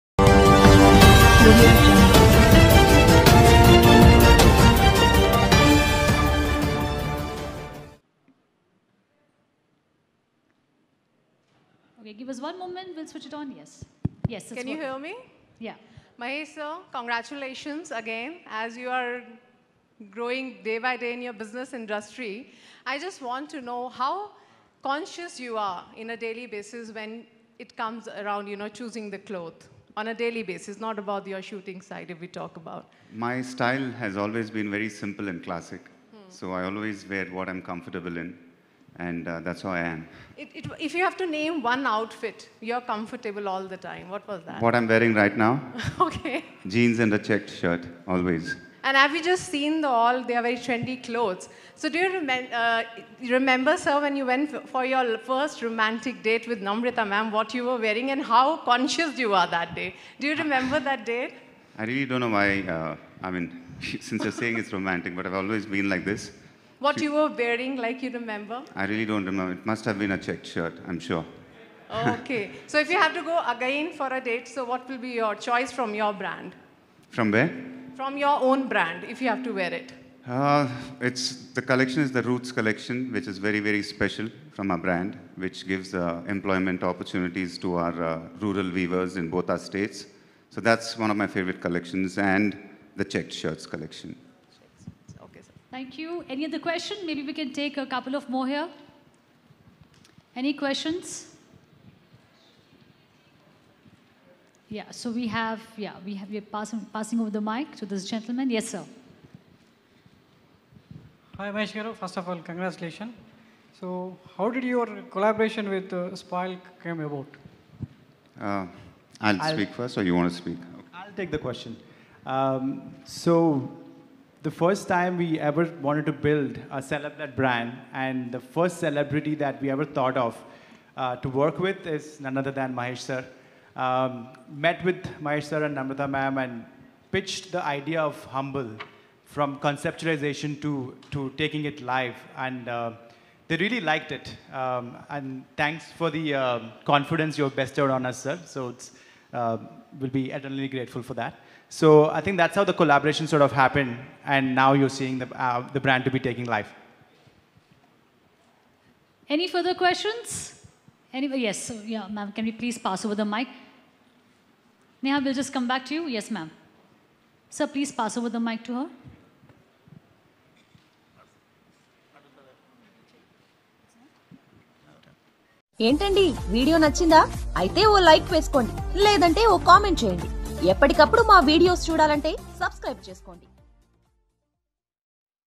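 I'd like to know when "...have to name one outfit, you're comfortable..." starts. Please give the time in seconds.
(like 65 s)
41 s.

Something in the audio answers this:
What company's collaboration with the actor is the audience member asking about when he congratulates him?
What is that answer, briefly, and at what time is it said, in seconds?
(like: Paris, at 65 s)
Spoil, at 116 s.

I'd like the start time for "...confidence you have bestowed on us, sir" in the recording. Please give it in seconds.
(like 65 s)
146 s.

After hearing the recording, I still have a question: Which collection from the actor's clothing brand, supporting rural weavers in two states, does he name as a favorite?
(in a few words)
Roots collection.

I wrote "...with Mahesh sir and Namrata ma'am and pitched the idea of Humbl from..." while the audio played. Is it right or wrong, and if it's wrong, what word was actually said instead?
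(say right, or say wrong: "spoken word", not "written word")
right.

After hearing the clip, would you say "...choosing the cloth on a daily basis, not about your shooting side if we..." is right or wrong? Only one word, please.
right.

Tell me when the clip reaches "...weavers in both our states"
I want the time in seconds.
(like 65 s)
88 s.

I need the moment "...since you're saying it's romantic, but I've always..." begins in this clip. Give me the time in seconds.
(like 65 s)
63 s.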